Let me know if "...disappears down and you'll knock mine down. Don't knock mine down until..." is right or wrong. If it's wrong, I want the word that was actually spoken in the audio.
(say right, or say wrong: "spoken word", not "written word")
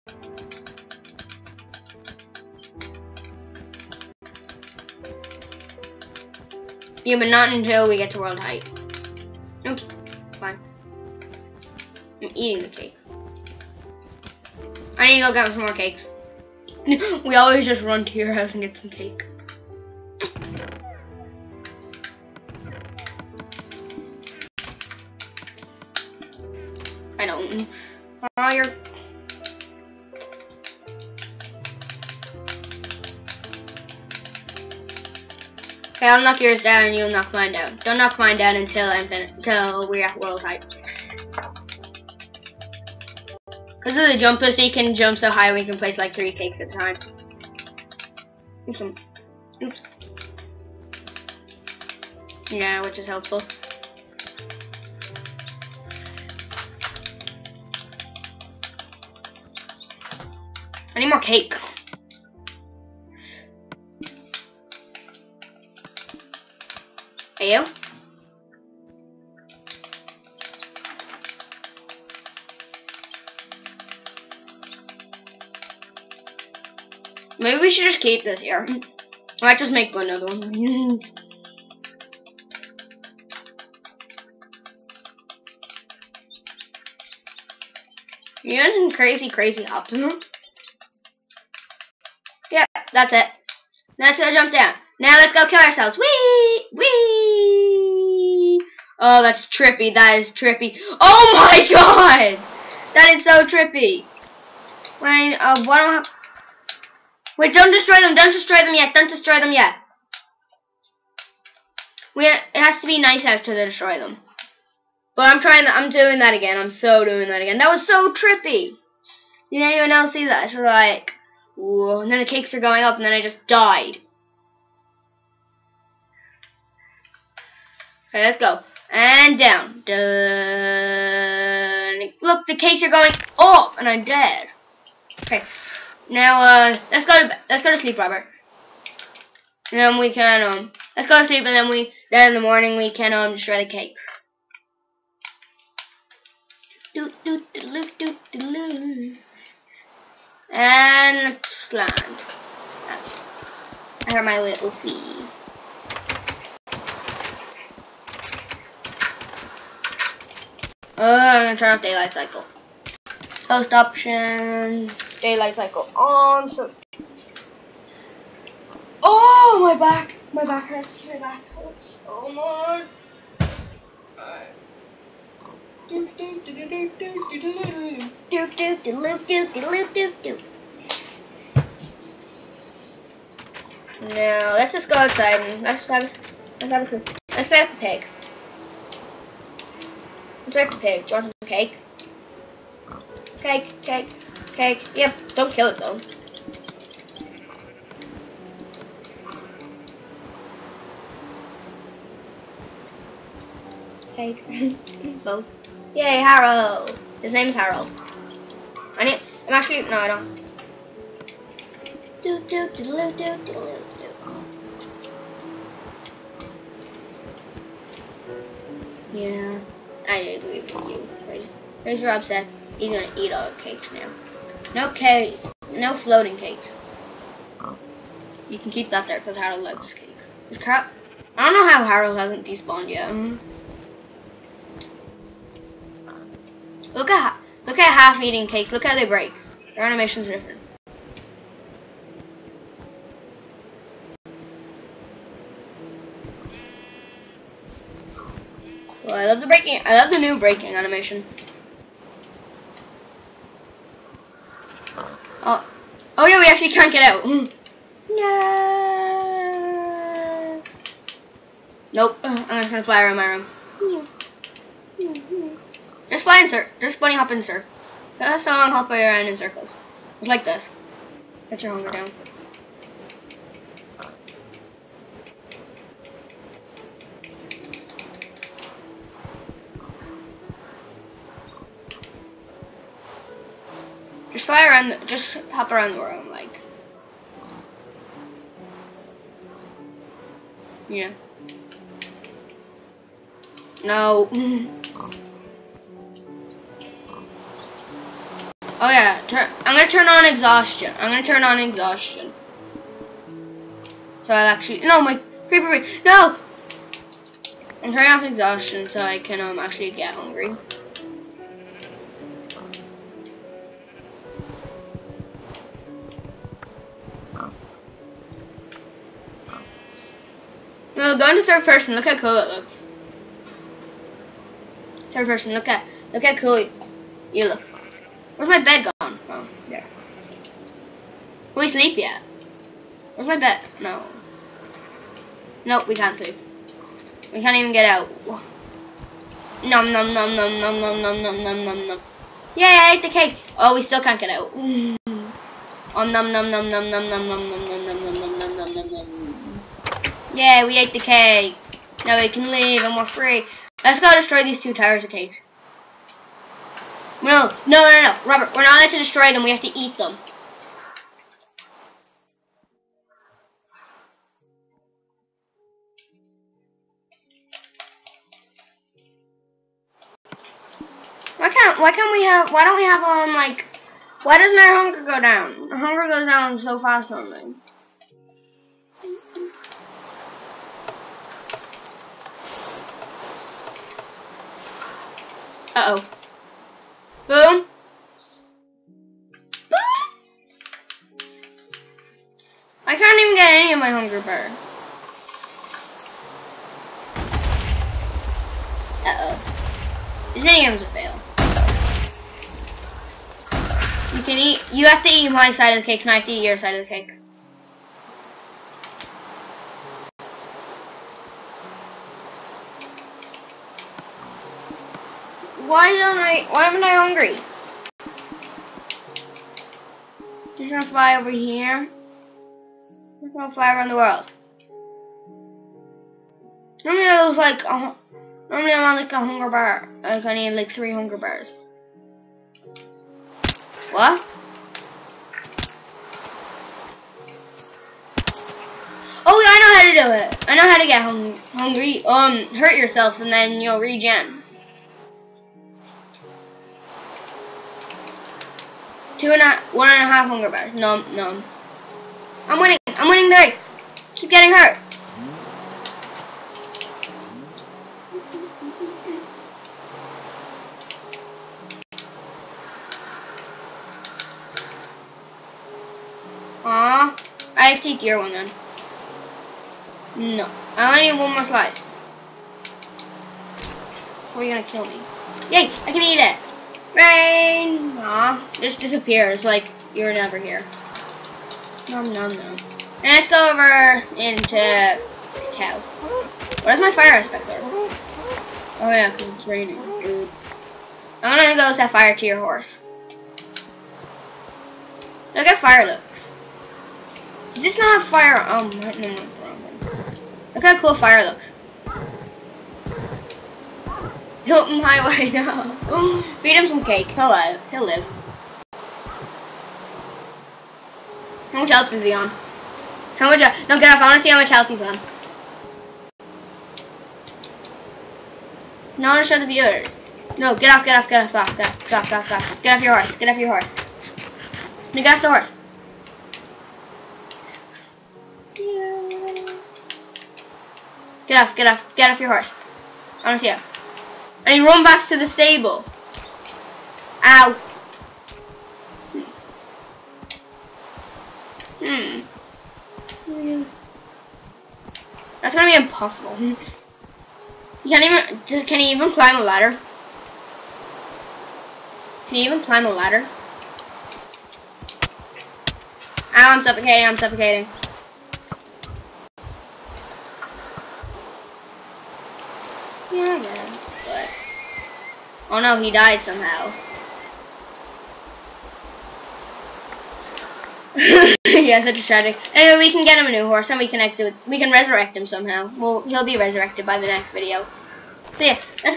wrong: "yours", not "disappears".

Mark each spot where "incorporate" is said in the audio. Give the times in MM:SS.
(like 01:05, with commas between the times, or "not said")
not said.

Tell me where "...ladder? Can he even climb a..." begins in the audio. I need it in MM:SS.
09:09.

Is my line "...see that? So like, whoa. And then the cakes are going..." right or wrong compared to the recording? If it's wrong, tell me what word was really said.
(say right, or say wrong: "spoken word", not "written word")
right.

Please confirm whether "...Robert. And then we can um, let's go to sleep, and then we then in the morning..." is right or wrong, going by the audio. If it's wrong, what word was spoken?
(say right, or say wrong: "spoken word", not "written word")
right.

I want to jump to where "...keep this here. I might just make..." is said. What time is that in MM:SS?
01:17.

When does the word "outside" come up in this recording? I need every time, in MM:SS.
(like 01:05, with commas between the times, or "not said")
03:04.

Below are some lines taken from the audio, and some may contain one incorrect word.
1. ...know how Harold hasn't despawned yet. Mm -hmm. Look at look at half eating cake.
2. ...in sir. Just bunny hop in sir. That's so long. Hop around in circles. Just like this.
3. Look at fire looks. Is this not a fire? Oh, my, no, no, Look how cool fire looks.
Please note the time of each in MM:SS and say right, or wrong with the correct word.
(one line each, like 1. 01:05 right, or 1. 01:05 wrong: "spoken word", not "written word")
1. 03:51 right
2. 04:26 right
3. 08:15 right.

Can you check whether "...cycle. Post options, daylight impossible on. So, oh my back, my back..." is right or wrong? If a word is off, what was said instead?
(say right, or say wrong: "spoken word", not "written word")
wrong: "cycle", not "impossible".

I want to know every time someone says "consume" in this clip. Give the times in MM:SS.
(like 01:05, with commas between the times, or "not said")
not said.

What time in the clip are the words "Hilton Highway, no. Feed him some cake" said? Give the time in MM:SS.
08:24.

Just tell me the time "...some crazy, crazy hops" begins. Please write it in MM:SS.
01:28.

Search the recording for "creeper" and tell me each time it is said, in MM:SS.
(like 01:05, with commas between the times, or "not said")
05:05.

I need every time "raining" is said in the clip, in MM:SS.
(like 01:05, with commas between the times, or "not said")
08:09.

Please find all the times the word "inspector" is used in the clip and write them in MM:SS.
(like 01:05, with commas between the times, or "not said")
08:07.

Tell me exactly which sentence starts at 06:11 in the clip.
Why can't, why can't we have, why don't we have, um, like, why doesn't our hunger go down?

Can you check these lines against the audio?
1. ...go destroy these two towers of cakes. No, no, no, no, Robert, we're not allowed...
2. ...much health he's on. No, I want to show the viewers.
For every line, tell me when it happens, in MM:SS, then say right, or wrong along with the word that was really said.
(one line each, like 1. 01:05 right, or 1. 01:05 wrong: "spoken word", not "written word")
1. 05:53 right
2. 08:34 right.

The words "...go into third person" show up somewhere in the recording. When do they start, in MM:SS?
05:21.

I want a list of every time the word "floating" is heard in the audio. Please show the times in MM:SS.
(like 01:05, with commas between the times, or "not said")
03:45.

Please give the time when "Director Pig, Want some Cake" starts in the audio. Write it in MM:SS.
03:10.